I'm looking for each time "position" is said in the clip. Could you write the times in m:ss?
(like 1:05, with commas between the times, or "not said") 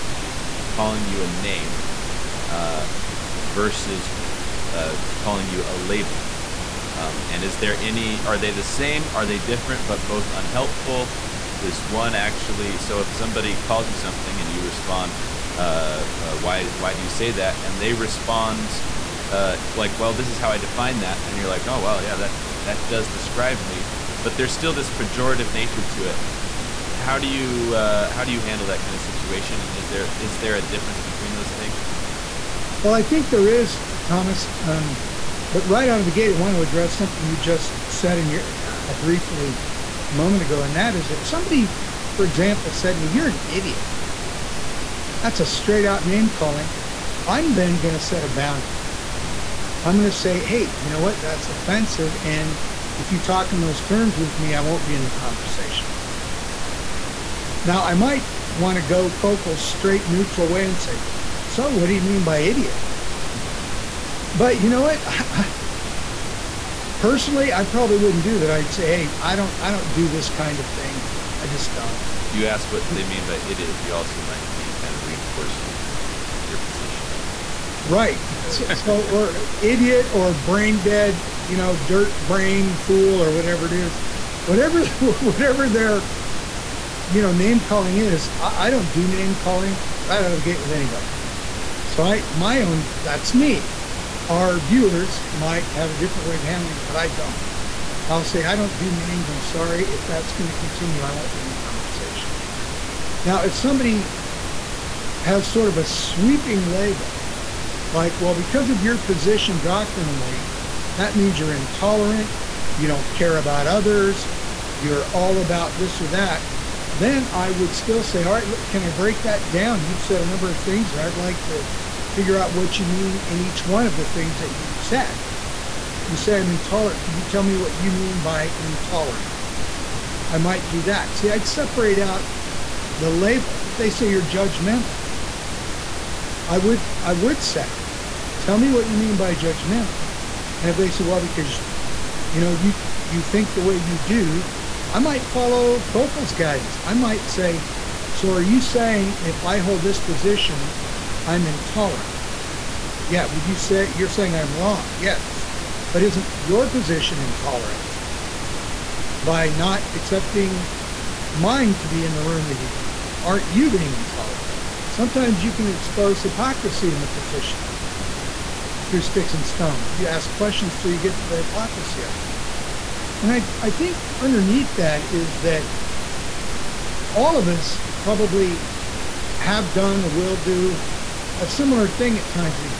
1:16, 1:48, 2:29, 2:36, 2:47.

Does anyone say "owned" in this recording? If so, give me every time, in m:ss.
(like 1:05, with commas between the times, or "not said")
not said.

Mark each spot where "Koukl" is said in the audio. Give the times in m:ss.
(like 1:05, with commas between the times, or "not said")
0:59, 2:25.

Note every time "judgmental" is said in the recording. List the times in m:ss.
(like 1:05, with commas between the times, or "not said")
2:14, 2:19.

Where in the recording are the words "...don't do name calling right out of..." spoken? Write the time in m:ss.
1:28.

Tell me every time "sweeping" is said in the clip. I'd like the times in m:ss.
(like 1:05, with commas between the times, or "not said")
1:45.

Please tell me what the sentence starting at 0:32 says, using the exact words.
Well, I think there is, Thomas.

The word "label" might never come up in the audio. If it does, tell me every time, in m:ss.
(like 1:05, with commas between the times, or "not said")
0:05, 1:46, 2:13.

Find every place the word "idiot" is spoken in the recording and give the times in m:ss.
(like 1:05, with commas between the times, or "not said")
0:43, 1:02, 1:13, 1:19.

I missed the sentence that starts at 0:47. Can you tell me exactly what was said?
I'm then going to set a boundary mm-hmm.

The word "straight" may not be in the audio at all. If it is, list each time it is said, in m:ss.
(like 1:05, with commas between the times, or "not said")
0:45, 0:59.